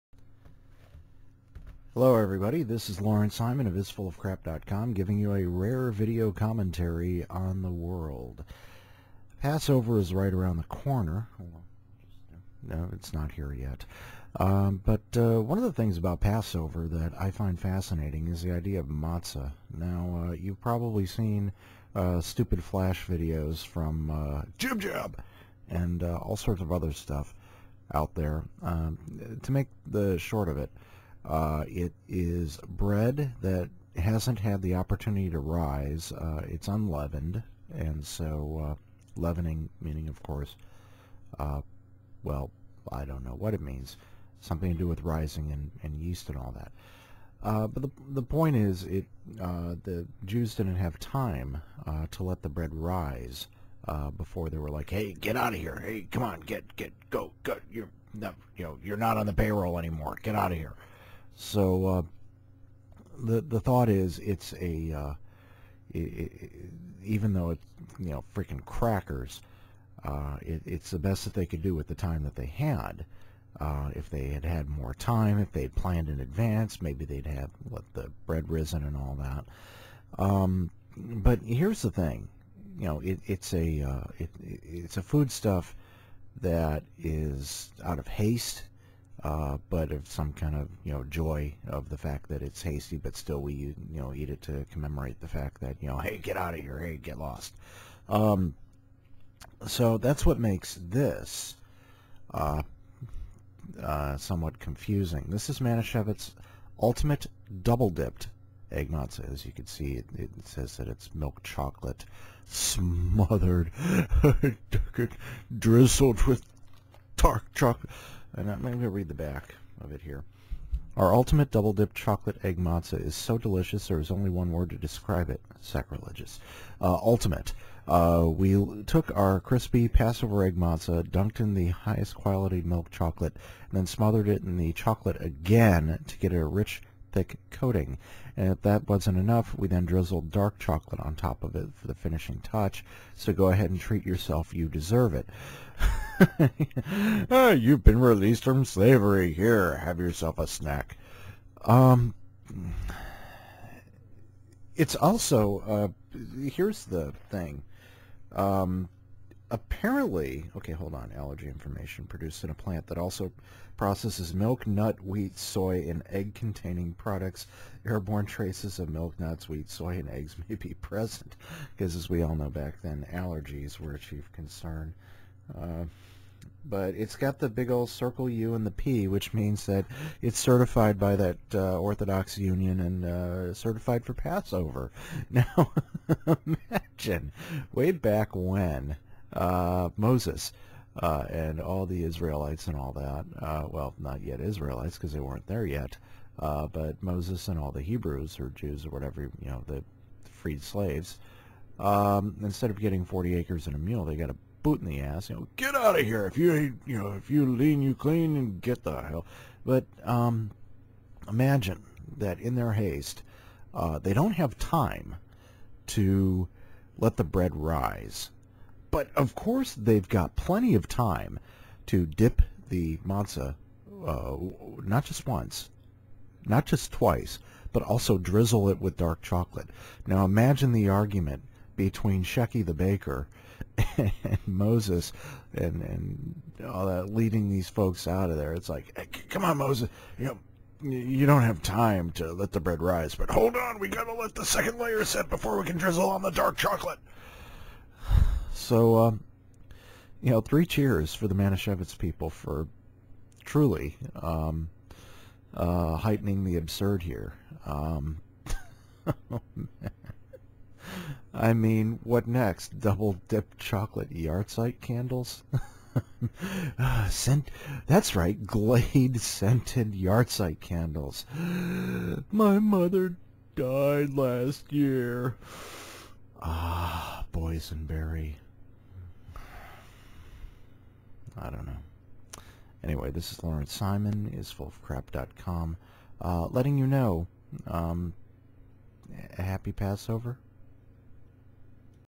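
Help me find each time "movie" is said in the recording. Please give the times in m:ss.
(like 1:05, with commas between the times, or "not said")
not said.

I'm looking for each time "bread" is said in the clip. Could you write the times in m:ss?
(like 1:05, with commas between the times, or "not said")
0:32, 0:52, 1:18, 3:37, 4:02.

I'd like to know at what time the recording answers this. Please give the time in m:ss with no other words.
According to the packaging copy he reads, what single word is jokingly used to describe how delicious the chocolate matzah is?
2:05.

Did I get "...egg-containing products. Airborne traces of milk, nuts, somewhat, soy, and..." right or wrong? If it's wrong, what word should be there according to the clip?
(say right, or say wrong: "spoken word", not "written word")
wrong: "wheat", not "somewhat".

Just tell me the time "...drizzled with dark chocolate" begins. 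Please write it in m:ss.
1:55.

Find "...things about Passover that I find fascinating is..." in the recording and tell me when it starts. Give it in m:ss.
0:15.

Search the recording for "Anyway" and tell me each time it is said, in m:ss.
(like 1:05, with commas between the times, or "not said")
4:42.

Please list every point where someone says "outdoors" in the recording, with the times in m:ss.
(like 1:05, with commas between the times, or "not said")
not said.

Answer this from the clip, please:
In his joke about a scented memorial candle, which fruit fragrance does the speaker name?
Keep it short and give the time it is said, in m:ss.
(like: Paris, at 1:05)
Boysenberry, at 4:37.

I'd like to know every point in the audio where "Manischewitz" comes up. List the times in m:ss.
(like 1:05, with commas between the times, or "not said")
1:45, 4:11.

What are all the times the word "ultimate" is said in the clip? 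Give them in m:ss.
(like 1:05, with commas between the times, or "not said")
1:46, 2:01, 2:06.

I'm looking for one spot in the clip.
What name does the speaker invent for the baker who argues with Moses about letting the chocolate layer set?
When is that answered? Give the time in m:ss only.
3:52.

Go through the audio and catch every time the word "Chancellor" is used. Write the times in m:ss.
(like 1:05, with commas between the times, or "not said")
not said.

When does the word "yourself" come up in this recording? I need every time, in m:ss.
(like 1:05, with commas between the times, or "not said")
2:24, 2:29.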